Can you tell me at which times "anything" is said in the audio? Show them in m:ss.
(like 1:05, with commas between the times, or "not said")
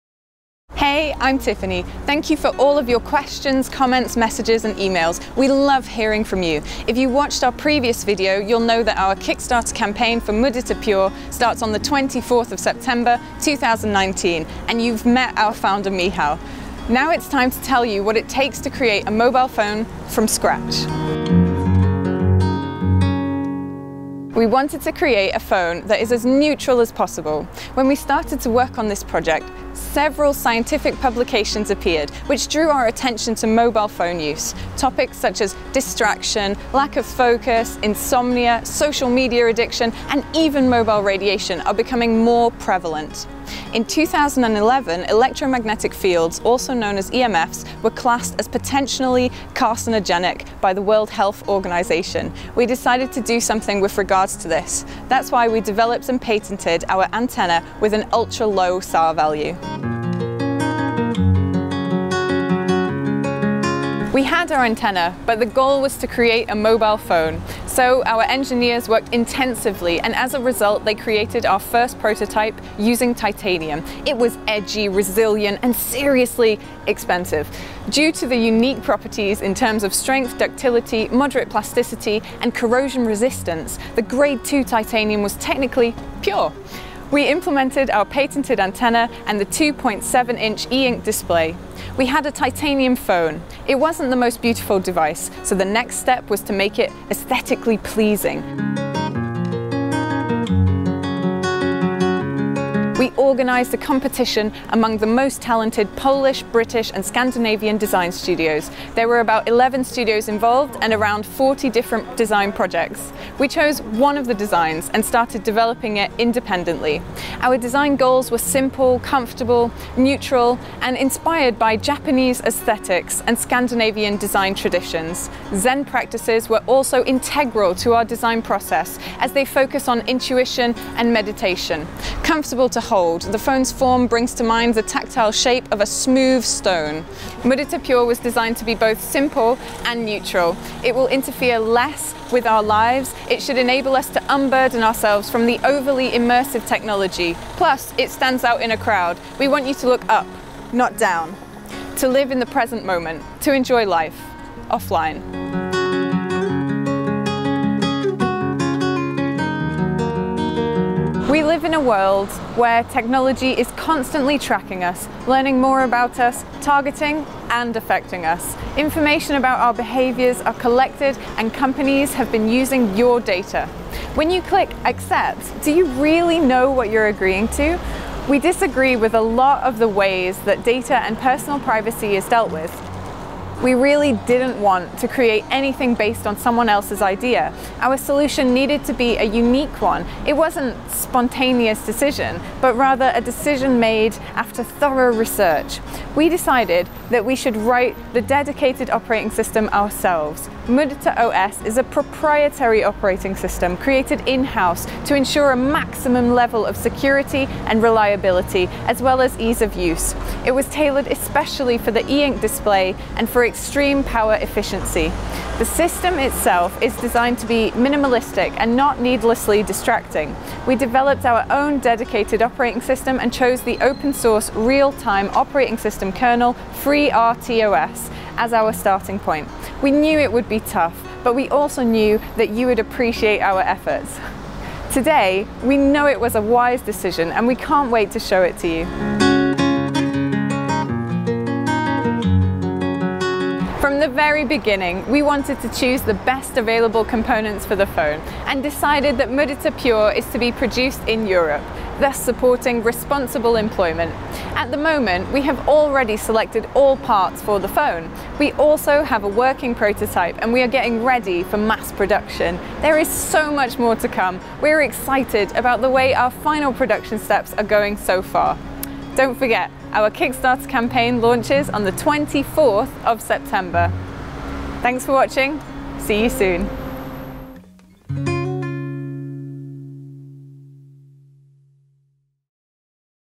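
3:05.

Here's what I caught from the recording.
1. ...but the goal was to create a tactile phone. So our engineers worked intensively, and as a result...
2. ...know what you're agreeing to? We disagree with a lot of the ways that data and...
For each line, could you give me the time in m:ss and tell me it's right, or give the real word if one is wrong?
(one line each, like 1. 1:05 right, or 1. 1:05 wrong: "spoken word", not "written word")
1. 1:05 wrong: "mobile", not "tactile"
2. 2:56 right.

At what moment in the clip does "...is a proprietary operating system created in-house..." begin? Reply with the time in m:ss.
3:21.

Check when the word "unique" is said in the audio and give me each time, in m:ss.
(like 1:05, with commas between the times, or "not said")
1:18, 3:09.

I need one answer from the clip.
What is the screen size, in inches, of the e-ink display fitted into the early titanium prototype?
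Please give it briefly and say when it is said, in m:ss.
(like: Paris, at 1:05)
2.7 inch, at 1:29.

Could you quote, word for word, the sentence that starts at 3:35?
The system itself is designed to be minimalistic and not needlessly distracting.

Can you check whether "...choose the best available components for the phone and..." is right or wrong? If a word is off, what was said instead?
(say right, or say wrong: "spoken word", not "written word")
right.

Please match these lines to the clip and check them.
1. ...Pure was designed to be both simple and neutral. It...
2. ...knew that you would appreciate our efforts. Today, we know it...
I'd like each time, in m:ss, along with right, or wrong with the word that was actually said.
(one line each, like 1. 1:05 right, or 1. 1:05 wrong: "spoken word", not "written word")
1. 2:17 right
2. 3:51 right.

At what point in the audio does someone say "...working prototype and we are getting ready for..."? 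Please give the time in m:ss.
4:19.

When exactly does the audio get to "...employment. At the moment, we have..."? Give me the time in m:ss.
4:13.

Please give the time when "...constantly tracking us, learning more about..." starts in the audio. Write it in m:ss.
2:43.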